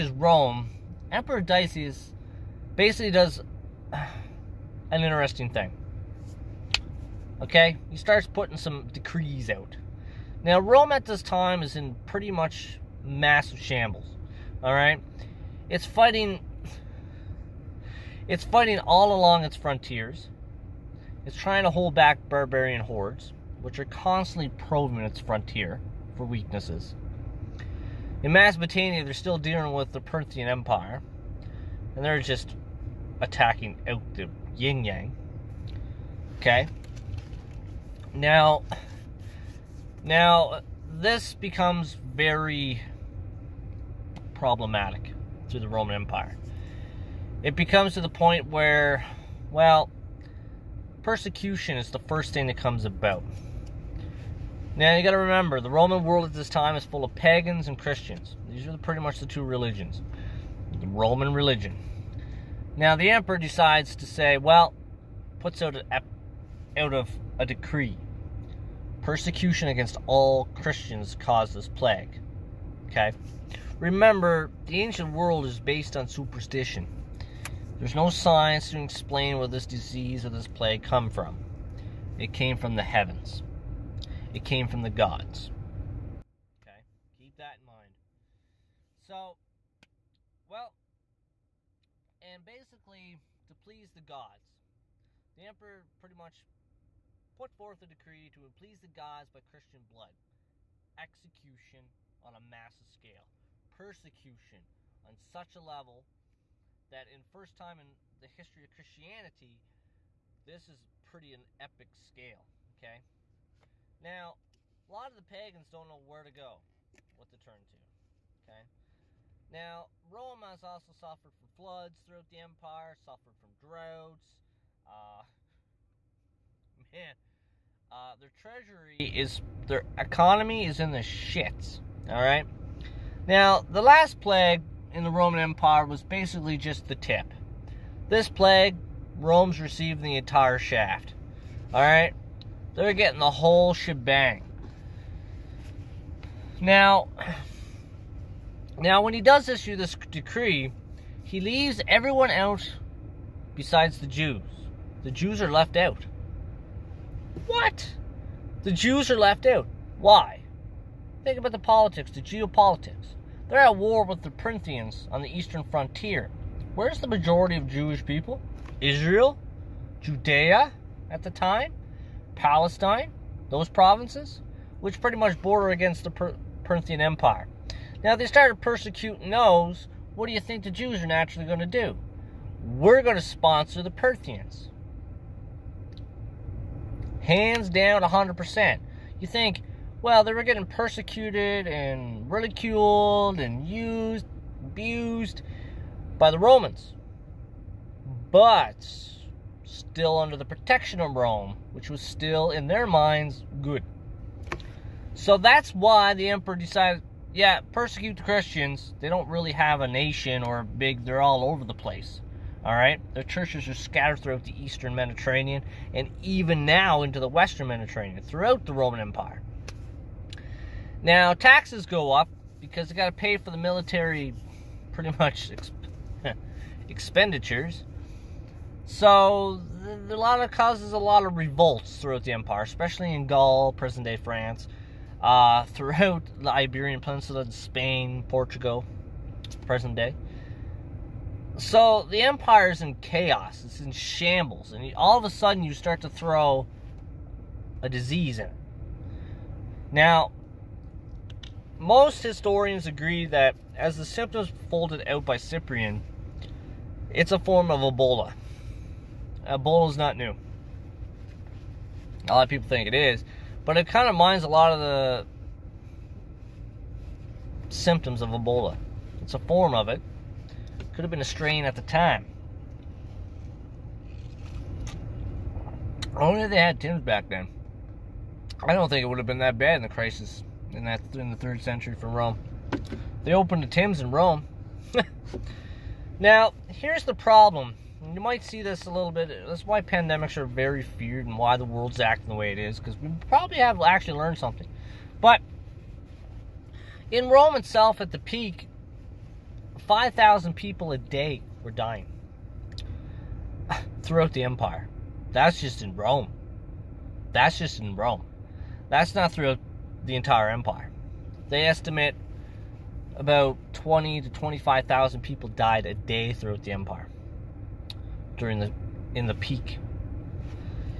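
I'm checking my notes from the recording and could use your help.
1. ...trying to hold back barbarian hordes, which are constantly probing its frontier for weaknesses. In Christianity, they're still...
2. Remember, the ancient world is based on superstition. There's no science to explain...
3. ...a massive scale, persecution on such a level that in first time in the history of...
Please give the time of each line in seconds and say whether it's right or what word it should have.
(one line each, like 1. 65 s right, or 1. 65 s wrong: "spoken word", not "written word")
1. 21 s wrong: "Mesopotamia", not "Christianity"
2. 73 s right
3. 102 s right.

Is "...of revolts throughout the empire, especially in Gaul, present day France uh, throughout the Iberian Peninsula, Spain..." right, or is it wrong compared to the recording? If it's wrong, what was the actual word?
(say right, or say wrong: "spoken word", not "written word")
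right.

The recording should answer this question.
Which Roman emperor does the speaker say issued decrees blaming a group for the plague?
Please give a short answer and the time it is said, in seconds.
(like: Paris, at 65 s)
Decius, at 1 s.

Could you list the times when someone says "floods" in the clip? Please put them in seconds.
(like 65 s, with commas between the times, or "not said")
121 s.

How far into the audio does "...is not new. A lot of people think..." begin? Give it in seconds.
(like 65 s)
259 s.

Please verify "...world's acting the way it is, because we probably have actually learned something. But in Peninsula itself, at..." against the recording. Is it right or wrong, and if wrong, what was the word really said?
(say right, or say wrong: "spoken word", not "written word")
wrong: "Rome", not "Peninsula".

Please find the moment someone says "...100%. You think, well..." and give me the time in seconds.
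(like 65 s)
188 s.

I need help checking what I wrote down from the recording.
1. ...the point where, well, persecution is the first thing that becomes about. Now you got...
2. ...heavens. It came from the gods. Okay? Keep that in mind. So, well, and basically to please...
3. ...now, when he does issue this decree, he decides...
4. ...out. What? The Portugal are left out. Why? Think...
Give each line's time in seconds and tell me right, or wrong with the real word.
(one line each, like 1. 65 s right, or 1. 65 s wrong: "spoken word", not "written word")
1. 48 s wrong: "comes", not "becomes"
2. 82 s right
3. 148 s wrong: "leaves", not "decides"
4. 155 s wrong: "Jews", not "Portugal".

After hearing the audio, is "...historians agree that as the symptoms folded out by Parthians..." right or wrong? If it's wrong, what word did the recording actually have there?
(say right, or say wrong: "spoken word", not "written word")
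wrong: "Cyprian", not "Parthians".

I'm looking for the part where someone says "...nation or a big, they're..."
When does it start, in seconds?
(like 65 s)
209 s.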